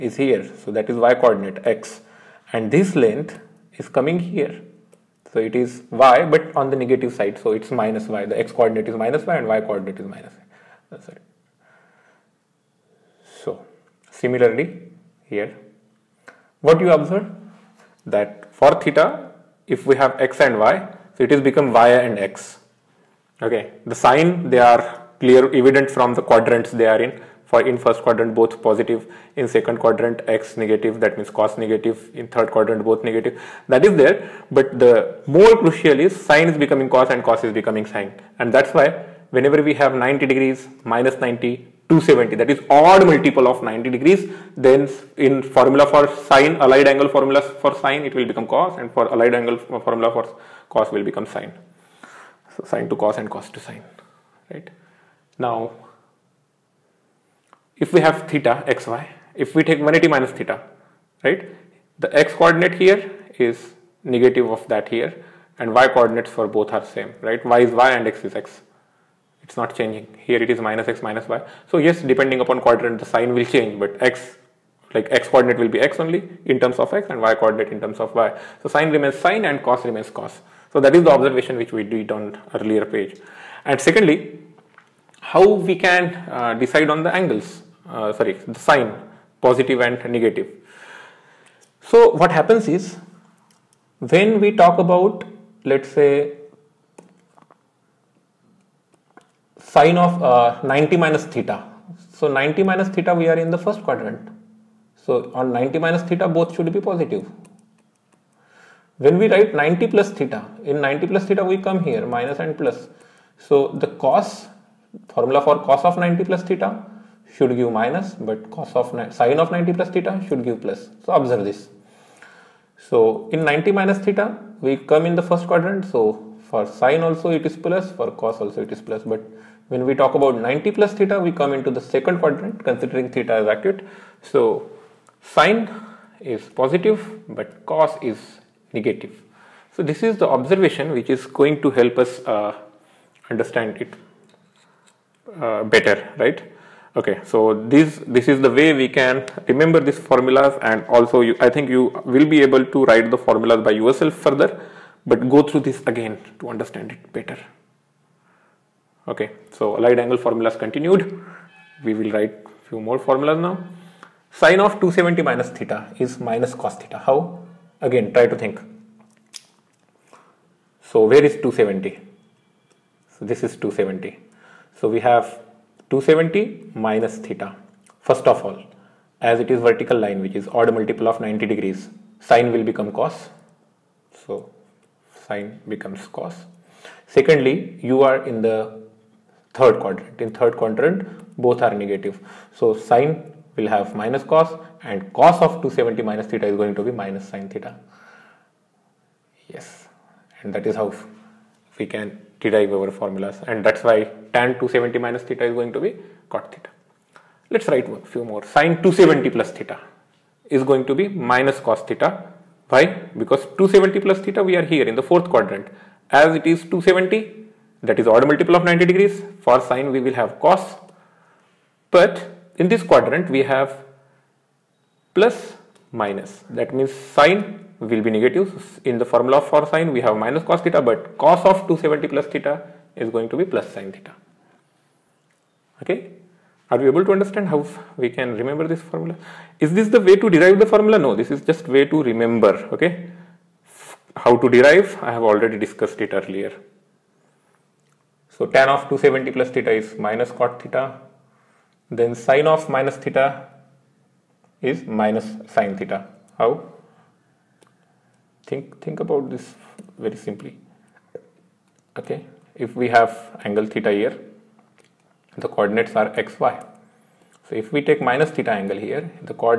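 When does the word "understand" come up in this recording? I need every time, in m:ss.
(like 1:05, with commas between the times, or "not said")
2:23, 2:36, 3:57.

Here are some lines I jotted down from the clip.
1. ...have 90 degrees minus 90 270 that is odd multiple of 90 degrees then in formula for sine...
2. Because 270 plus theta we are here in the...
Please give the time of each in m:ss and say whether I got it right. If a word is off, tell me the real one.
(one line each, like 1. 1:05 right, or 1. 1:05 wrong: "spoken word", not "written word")
1. 0:39 right
2. 3:33 right.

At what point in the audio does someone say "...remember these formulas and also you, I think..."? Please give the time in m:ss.
2:29.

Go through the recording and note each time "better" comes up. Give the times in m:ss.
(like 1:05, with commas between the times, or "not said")
2:25, 2:37.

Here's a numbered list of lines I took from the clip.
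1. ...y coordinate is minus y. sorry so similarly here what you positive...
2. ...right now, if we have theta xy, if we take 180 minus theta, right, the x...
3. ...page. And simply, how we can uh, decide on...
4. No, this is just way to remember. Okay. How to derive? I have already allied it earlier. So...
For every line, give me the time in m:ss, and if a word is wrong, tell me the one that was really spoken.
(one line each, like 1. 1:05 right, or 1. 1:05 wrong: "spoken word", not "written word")
1. 0:09 wrong: "observe", not "positive"
2. 0:54 right
3. 1:22 wrong: "secondly", not "simply"
4. 4:00 wrong: "discussed", not "allied".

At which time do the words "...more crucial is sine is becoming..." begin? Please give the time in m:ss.
0:35.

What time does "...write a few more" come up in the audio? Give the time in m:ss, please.
3:27.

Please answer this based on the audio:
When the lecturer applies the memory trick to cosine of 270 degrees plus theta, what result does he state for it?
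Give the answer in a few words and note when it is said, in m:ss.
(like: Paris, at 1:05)
plus sine theta, at 3:53.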